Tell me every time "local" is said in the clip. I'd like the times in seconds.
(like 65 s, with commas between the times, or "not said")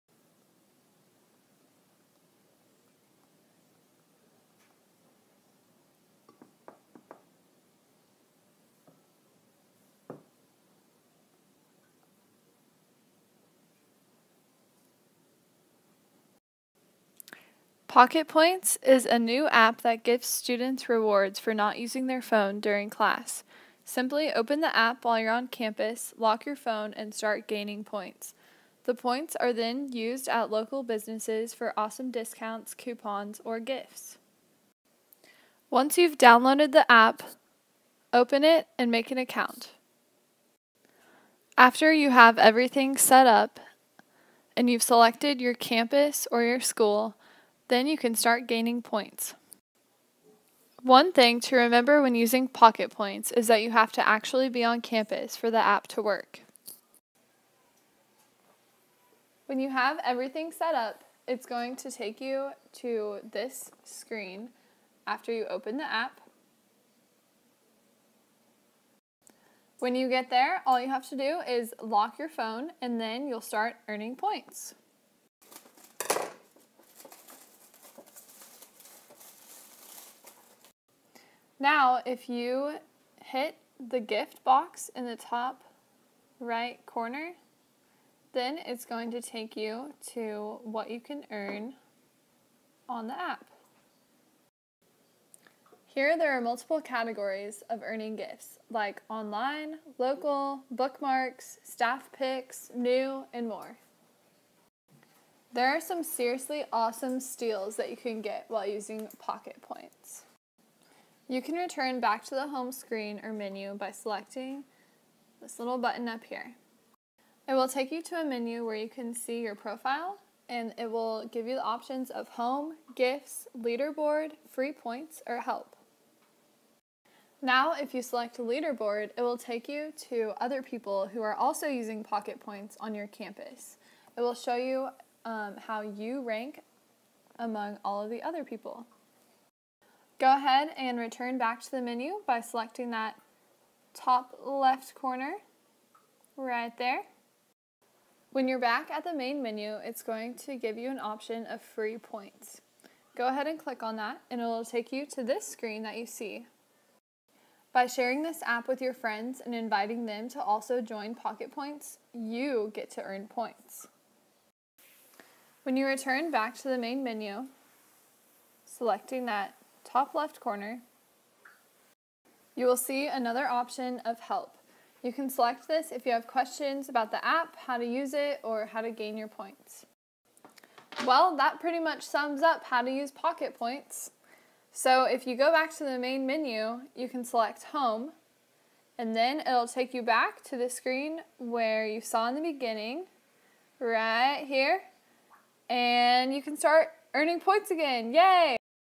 30 s, 99 s.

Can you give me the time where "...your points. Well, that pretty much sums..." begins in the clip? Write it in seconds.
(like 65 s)
179 s.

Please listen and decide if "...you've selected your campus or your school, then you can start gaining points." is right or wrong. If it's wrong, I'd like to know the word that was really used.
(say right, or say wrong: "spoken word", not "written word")
right.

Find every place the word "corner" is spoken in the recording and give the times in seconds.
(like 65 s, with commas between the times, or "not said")
86 s, 144 s, 170 s.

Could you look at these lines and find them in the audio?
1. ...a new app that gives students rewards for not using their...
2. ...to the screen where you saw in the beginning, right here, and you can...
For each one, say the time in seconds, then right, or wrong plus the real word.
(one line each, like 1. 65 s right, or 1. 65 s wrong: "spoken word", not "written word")
1. 19 s right
2. 190 s right.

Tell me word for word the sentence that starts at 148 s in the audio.
When you're back at the main menu, it's going to give you an option of free points.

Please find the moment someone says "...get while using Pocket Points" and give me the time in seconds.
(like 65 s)
108 s.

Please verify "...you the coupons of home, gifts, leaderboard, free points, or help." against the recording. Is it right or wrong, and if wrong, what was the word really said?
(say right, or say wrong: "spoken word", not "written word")
wrong: "options", not "coupons".